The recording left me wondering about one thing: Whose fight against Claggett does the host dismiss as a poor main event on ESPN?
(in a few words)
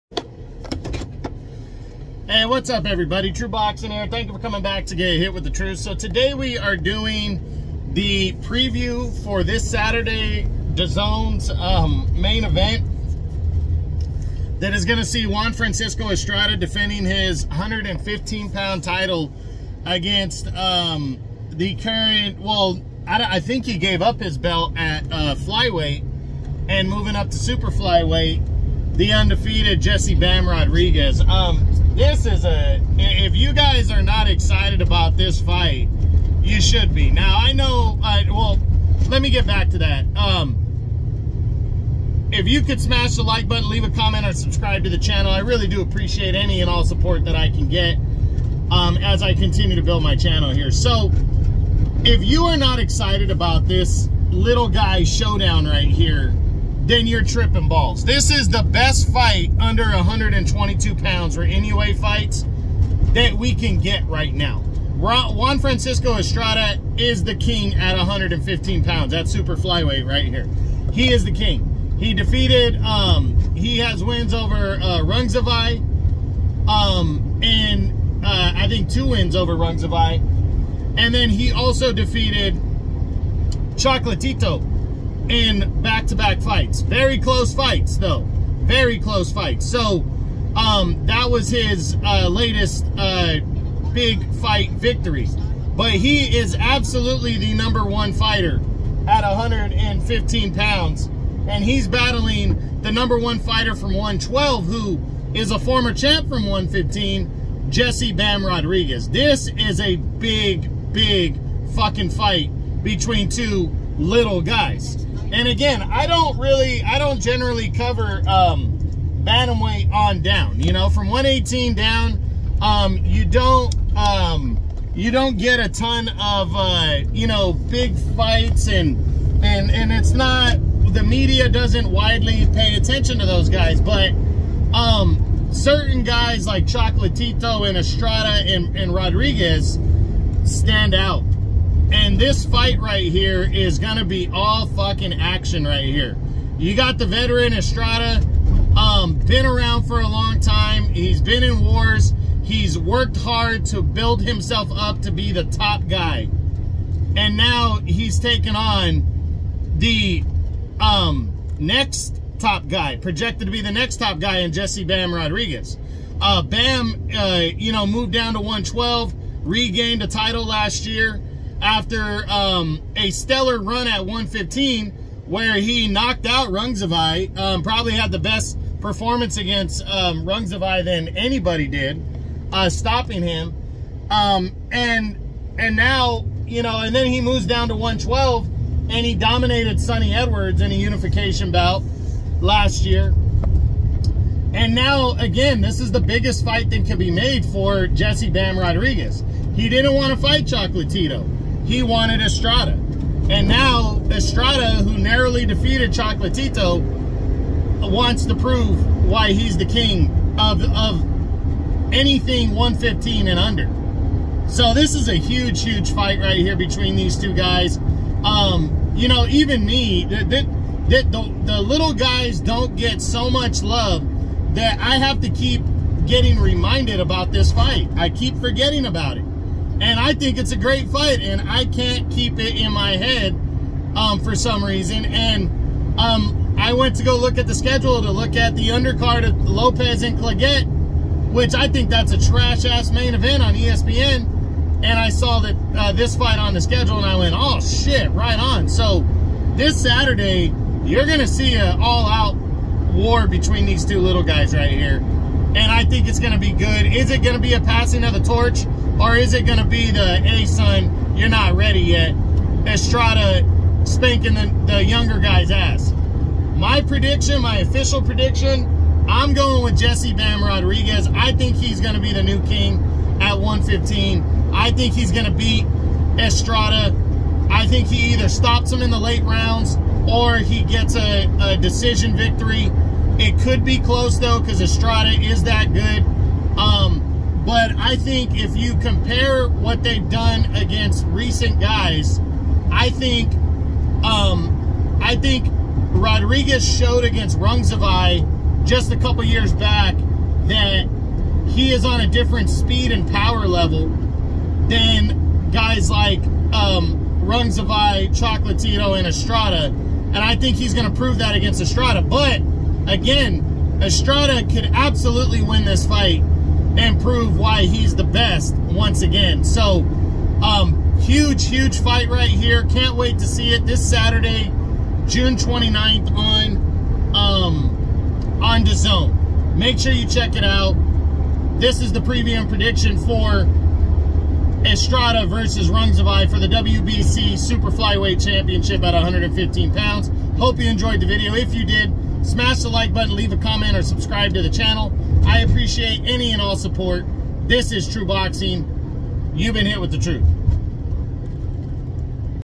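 Lopez.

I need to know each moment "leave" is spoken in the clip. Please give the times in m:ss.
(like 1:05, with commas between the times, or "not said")
0:43, 5:43.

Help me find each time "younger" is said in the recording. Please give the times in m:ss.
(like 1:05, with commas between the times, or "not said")
4:24.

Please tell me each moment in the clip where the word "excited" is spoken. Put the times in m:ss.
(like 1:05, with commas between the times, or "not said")
0:34, 0:52.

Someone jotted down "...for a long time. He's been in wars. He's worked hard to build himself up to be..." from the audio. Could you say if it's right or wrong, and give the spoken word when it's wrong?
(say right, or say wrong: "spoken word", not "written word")
right.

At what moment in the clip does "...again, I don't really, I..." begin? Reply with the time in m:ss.
1:55.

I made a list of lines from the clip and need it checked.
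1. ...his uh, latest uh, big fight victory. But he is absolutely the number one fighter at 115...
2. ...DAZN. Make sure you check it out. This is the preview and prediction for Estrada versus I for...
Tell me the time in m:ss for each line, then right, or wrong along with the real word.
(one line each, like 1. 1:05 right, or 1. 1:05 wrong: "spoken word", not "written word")
1. 1:31 right
2. 5:28 right.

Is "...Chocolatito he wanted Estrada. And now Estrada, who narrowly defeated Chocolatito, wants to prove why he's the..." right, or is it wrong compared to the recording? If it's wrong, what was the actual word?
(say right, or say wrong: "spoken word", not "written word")
right.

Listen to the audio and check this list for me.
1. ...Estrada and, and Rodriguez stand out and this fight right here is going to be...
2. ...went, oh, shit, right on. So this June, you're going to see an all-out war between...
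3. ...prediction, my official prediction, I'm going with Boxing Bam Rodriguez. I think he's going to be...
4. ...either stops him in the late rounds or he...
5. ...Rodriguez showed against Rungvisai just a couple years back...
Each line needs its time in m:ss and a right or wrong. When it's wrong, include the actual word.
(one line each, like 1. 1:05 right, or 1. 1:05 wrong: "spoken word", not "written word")
1. 2:17 right
2. 4:07 wrong: "Saturday", not "June"
3. 4:26 wrong: "Jesse", not "Boxing"
4. 4:38 right
5. 4:55 right.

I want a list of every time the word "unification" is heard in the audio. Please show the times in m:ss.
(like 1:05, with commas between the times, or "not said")
3:10.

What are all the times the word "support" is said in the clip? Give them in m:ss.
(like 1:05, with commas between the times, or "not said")
0:46, 5:46.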